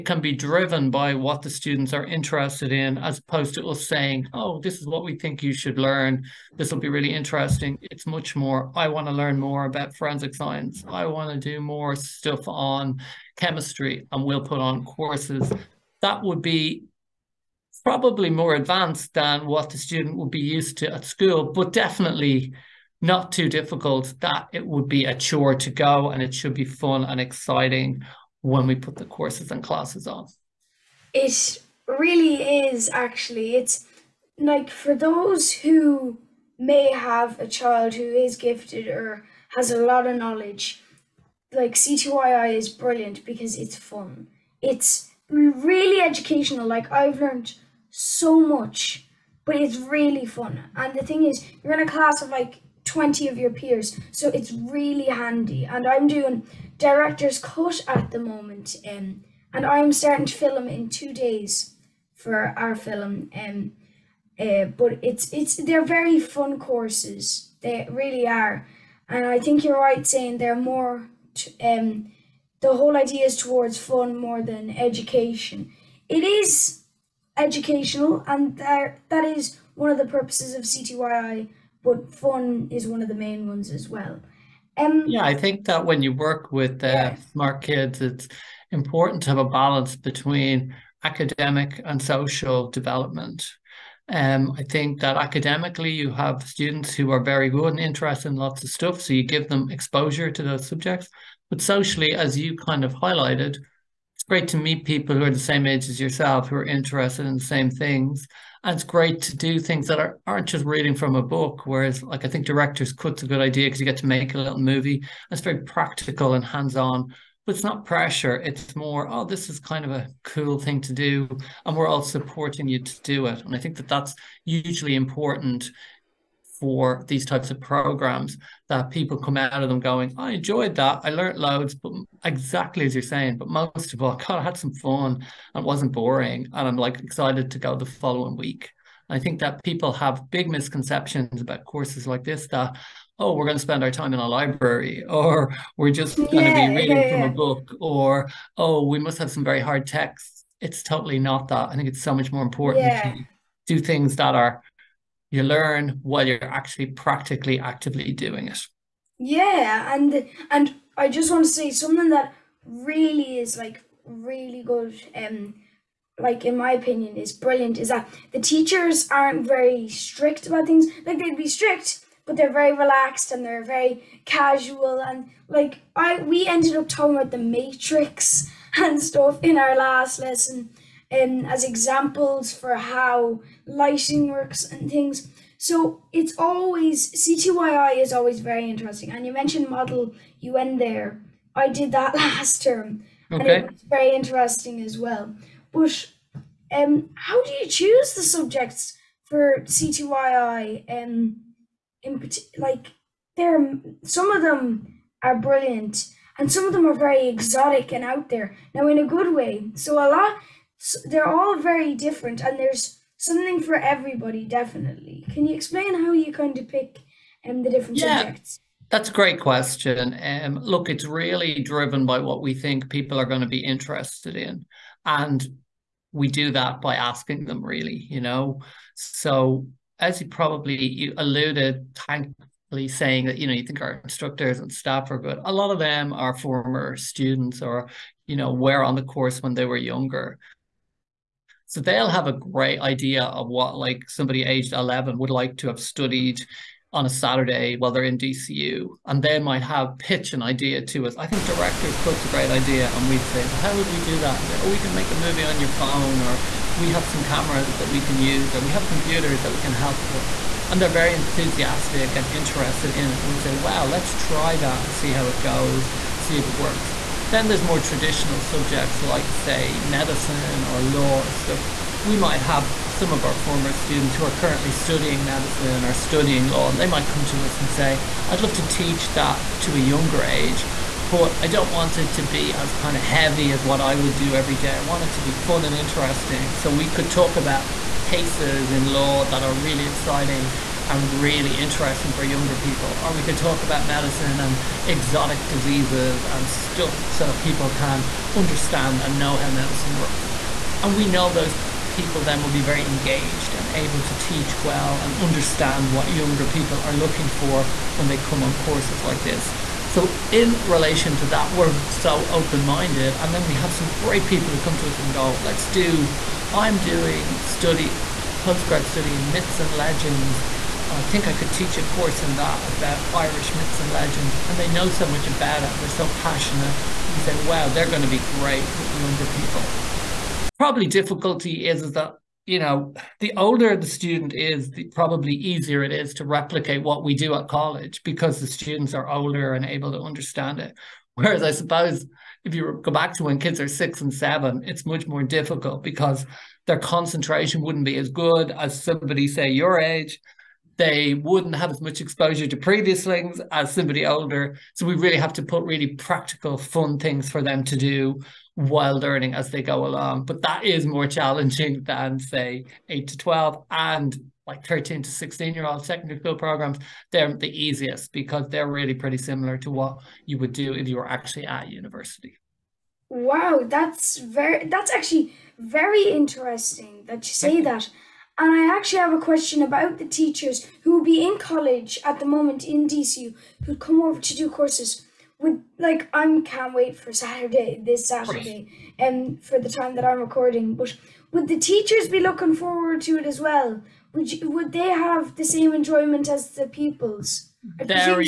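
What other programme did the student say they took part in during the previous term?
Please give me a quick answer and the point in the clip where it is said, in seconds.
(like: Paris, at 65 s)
Model UN, at 189 s.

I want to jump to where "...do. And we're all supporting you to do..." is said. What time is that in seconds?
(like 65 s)
120 s.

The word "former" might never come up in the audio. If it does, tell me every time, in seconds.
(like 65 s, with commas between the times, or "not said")
236 s, 273 s.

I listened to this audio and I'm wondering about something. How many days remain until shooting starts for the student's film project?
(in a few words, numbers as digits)
2 days.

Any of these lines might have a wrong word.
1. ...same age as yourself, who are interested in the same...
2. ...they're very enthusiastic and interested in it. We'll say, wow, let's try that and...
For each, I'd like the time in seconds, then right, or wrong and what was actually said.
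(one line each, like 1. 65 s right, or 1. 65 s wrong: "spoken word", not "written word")
1. 105 s right
2. 260 s right.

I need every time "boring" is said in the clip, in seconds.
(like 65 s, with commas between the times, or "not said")
135 s.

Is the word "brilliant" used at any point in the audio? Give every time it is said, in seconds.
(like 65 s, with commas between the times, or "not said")
42 s, 167 s, 205 s.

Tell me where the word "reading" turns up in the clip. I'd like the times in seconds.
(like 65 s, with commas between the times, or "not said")
110 s, 146 s.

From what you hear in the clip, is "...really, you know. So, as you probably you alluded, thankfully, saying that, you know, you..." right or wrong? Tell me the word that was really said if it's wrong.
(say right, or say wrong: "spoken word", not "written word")
right.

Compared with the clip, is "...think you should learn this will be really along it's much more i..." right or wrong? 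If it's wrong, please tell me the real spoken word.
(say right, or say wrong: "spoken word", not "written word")
wrong: "interesting", not "along".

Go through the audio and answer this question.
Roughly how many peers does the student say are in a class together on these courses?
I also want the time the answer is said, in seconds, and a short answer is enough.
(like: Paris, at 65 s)
20, at 52 s.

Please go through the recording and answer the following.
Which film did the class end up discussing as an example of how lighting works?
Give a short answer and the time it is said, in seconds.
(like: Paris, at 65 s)
The Matrix, at 177 s.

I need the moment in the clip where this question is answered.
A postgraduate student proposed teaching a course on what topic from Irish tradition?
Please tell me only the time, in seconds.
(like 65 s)
323 s.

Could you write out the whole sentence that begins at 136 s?
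And I'm like excited to go the following week.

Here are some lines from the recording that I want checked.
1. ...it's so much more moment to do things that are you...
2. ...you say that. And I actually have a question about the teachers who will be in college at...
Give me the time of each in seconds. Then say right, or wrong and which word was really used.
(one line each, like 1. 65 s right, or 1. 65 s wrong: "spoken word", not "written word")
1. 151 s wrong: "important", not "moment"
2. 377 s right.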